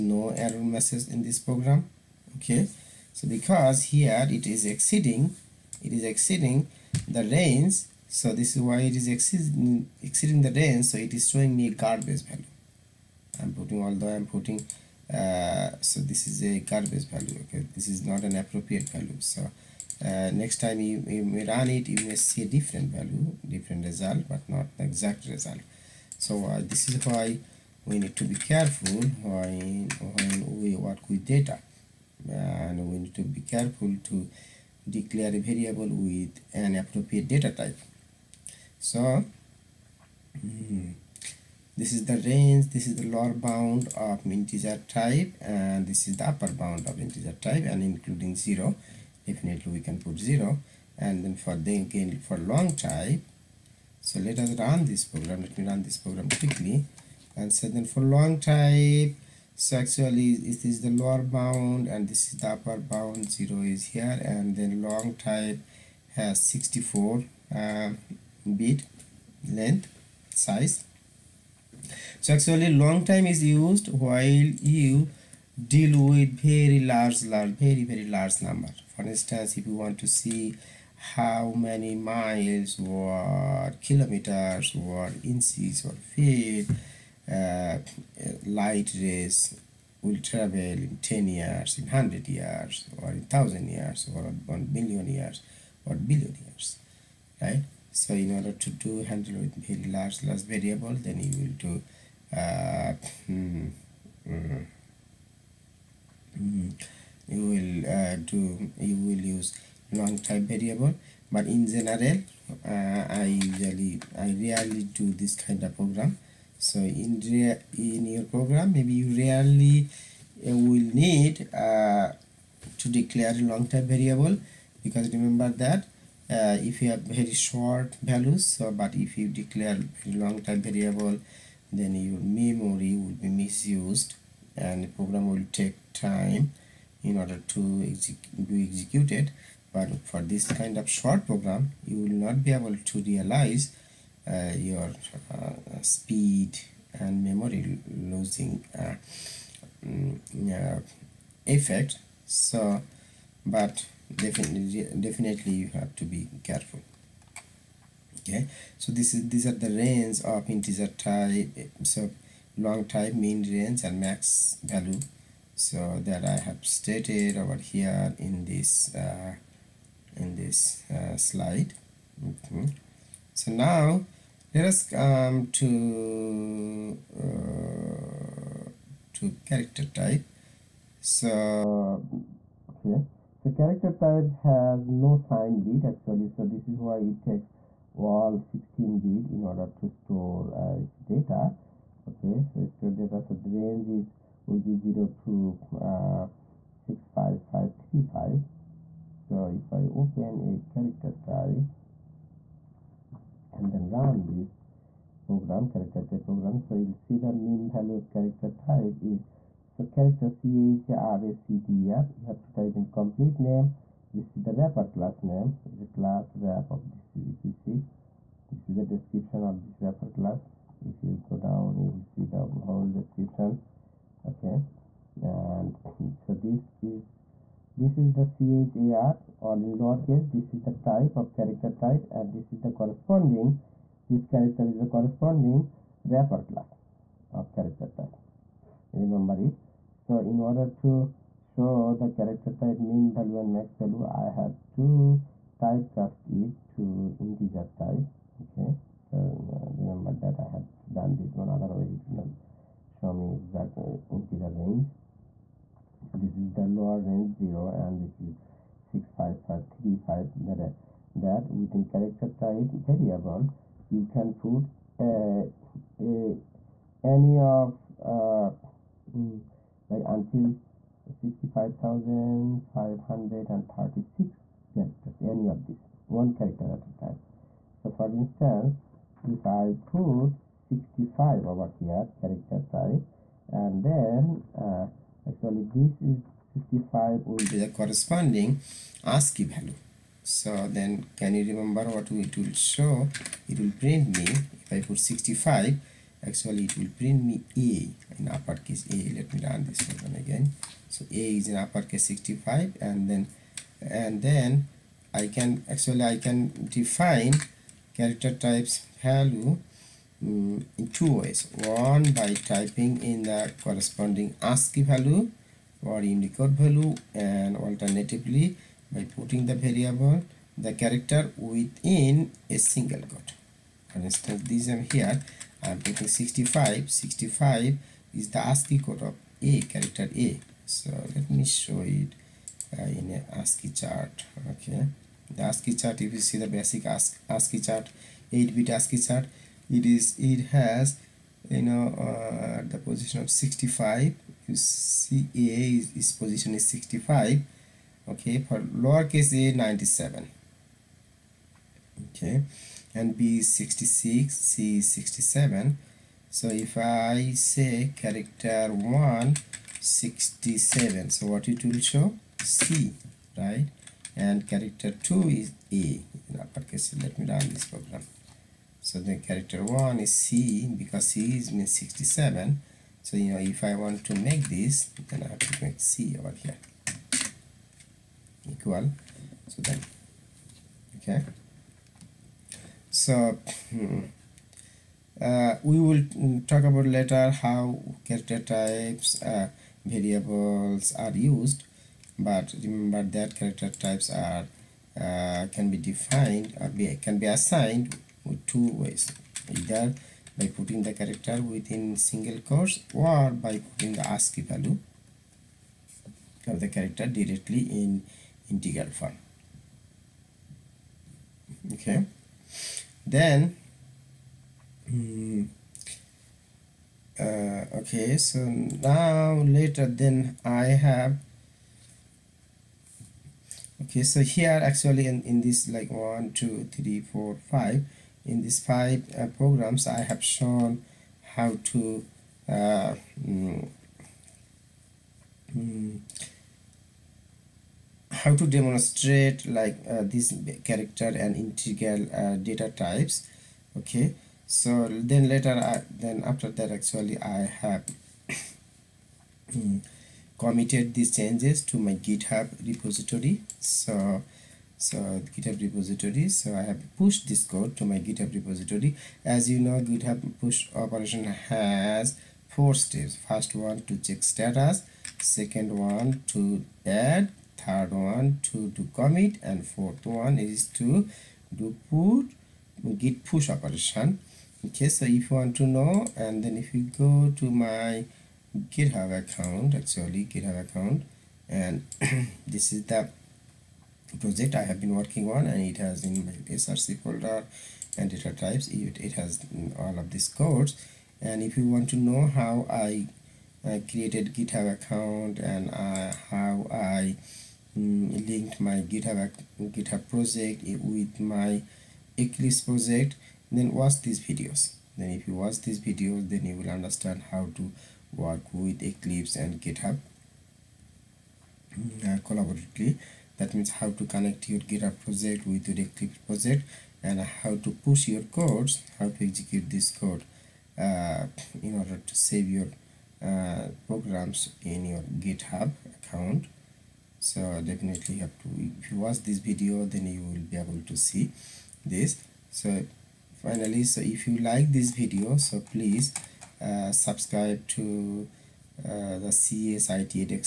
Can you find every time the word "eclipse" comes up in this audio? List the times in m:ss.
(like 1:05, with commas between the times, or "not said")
8:22, 8:28, 8:35.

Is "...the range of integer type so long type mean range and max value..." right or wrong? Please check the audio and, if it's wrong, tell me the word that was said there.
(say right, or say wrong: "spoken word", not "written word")
right.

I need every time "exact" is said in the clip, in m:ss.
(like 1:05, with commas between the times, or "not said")
0:24, 4:13.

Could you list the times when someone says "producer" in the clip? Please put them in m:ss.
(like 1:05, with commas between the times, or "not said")
not said.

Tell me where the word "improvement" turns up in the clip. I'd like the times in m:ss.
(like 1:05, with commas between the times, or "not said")
not said.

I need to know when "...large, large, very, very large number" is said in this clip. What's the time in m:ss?
1:16.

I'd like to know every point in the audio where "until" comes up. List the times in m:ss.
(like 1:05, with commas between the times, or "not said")
4:30.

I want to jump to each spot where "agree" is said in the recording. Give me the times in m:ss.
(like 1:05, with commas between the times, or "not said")
not said.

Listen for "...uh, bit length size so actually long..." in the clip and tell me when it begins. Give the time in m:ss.
1:07.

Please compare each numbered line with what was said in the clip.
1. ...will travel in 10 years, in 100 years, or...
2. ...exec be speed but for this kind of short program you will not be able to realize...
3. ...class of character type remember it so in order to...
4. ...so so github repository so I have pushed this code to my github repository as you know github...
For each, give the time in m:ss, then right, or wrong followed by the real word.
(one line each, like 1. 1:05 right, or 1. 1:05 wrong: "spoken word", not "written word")
1. 1:29 right
2. 2:17 wrong: "executed", not "speed"
3. 3:56 right
4. 7:33 right.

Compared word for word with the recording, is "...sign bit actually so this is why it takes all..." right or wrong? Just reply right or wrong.
right.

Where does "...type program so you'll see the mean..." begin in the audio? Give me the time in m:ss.
3:26.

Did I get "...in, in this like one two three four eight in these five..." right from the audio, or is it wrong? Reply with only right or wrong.
wrong.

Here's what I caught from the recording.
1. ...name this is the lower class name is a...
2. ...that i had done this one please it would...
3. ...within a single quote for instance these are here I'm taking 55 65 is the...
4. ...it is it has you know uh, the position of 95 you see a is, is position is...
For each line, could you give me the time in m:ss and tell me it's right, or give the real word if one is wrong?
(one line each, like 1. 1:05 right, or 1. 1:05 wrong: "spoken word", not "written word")
1. 3:33 wrong: "wrapper", not "lower"
2. 4:10 wrong: "otherwise", not "please"
3. 5:21 wrong: "65", not "55"
4. 5:39 wrong: "65", not "95".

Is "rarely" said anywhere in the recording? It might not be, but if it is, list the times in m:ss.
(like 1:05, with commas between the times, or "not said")
1:54, 1:59.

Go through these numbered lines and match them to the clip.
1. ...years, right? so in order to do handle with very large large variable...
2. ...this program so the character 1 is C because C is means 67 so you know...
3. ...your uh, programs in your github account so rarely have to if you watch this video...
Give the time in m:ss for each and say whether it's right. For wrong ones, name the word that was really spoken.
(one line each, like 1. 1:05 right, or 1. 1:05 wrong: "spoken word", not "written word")
1. 1:36 right
2. 6:07 right
3. 8:42 wrong: "definitely", not "rarely".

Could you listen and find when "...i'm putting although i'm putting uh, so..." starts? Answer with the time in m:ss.
0:13.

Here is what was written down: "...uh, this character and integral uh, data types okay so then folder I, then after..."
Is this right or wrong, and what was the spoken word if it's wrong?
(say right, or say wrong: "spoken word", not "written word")
wrong: "later", not "folder".